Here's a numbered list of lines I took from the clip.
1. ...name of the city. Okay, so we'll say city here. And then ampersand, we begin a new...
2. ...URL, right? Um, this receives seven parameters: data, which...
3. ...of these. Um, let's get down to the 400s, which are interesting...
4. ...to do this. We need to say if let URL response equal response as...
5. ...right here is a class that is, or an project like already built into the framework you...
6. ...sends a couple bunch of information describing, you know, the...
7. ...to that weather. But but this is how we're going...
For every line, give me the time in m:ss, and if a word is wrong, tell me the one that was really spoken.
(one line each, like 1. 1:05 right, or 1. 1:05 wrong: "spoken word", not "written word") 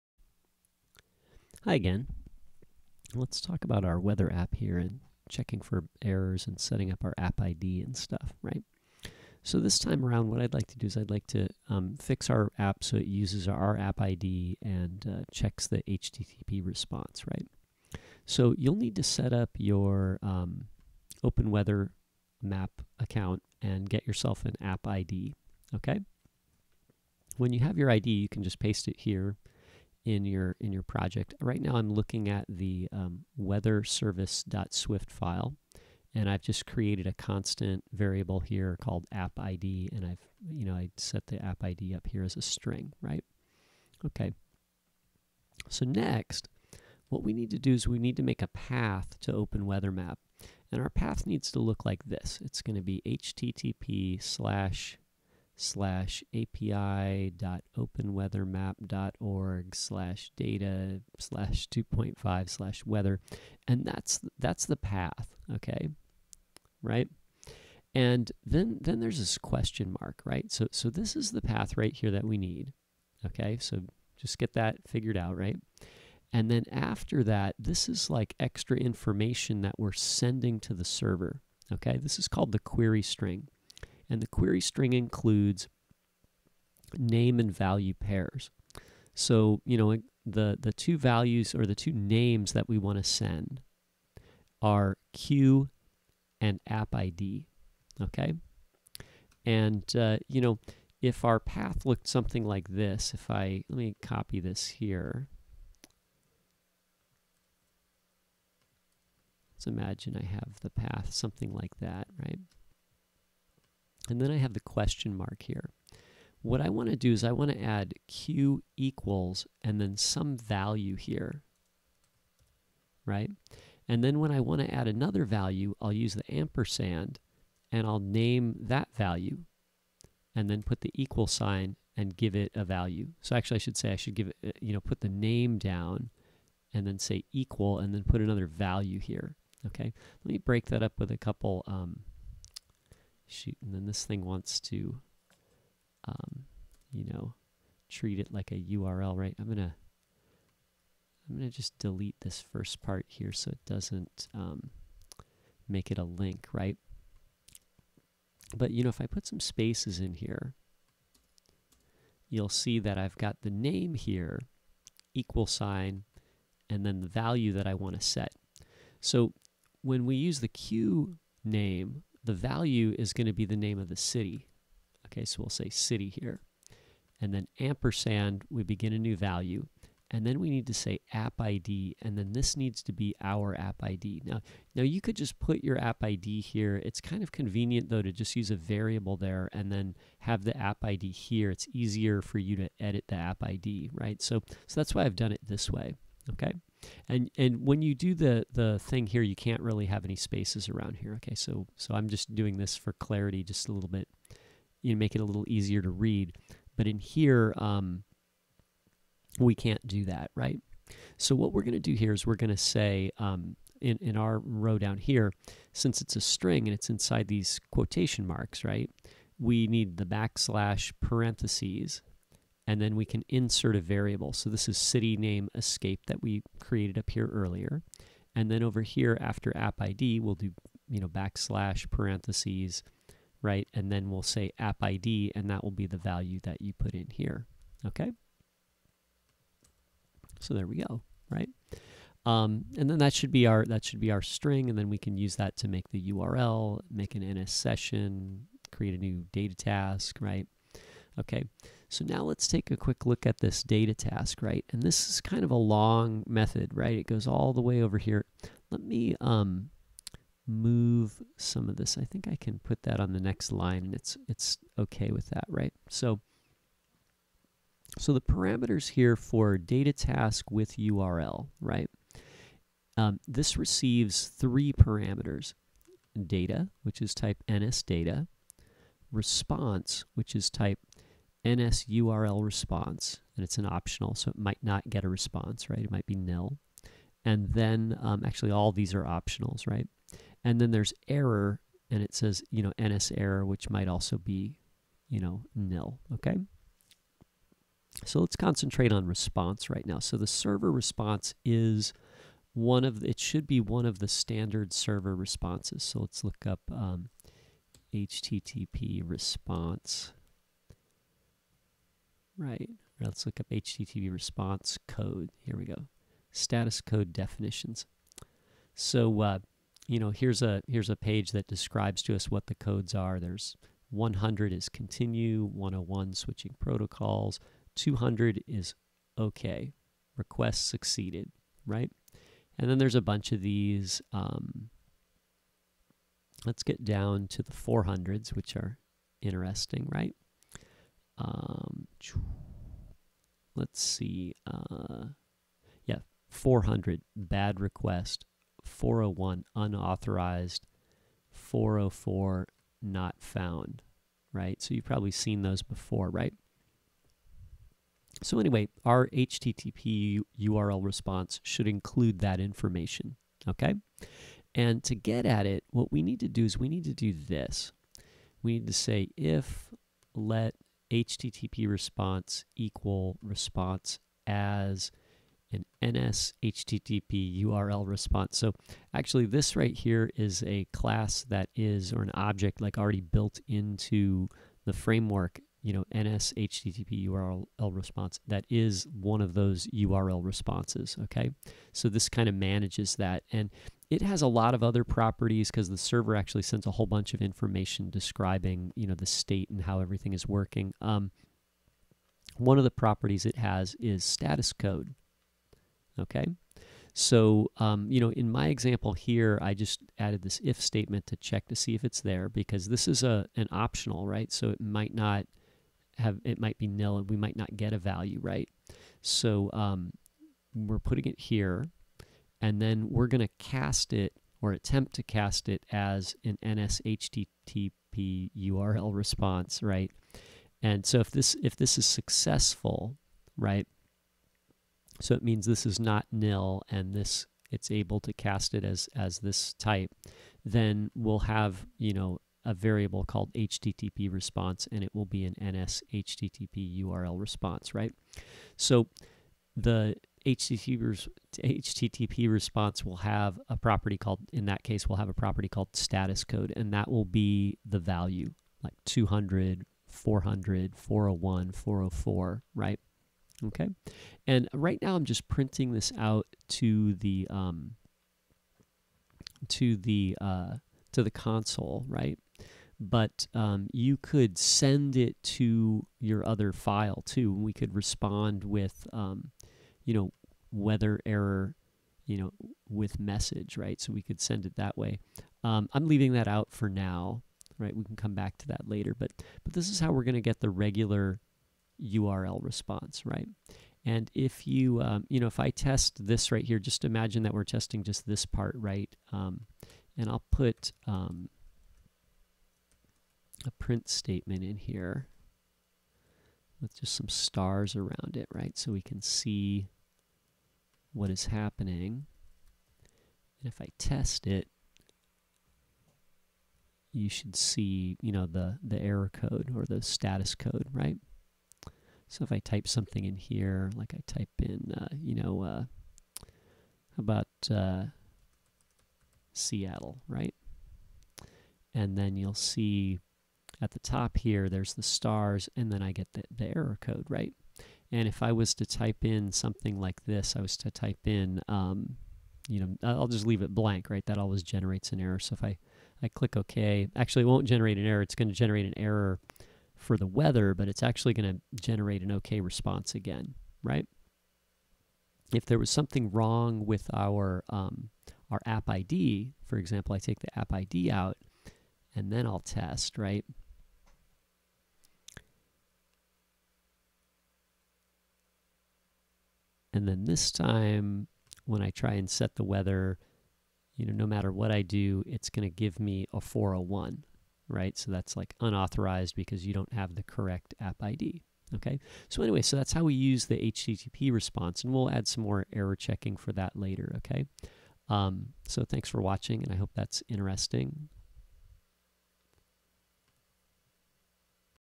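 1. 2:53 right
2. 4:30 wrong: "three", not "seven"
3. 5:33 right
4. 6:06 wrong: "HTTP", not "URL"
5. 6:19 wrong: "object", not "project"
6. 6:36 wrong: "whole", not "couple"
7. 8:08 wrong: "later", not "weather".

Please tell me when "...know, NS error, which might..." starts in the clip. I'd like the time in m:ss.
4:52.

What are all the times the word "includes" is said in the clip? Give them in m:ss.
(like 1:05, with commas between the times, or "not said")
1:24, 6:01.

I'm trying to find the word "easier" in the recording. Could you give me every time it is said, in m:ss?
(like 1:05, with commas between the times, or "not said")
3:11, 3:25.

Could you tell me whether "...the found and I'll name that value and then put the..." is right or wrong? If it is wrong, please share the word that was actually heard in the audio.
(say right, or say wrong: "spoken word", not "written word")
wrong: "ampersand", not "found".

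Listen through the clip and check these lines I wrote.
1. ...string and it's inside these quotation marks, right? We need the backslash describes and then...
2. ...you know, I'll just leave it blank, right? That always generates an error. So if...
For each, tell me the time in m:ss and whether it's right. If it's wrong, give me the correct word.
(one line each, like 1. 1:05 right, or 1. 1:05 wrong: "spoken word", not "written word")
1. 3:36 wrong: "parentheses", not "describes"
2. 9:02 right.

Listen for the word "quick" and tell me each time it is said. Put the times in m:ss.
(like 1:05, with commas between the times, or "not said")
4:12.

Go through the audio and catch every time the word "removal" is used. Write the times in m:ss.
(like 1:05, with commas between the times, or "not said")
not said.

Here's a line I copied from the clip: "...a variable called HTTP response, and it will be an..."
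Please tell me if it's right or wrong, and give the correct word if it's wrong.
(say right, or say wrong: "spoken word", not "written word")
right.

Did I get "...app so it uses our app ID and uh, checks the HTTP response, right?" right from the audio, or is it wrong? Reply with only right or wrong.
right.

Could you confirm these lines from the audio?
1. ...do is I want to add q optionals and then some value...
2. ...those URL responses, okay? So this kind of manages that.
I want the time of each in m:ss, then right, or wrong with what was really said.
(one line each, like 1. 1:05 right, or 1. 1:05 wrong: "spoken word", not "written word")
1. 1:56 wrong: "equals", not "optionals"
2. 6:29 right.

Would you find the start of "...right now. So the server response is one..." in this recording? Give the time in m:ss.
4:59.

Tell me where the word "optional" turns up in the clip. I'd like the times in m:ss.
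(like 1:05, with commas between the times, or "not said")
4:43, 4:49, 6:53.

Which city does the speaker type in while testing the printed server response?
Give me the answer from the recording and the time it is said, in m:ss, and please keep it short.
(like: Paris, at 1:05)
Seattle, at 8:49.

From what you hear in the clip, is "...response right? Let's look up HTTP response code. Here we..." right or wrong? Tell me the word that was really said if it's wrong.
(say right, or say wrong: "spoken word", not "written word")
right.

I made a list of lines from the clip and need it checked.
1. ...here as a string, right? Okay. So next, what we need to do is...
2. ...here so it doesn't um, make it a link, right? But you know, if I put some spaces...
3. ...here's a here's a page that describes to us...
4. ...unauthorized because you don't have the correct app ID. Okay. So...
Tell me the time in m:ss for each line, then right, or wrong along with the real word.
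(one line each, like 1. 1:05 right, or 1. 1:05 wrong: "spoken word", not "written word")
1. 0:42 right
2. 2:33 right
3. 5:20 right
4. 9:38 right.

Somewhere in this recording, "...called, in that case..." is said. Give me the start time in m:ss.
7:33.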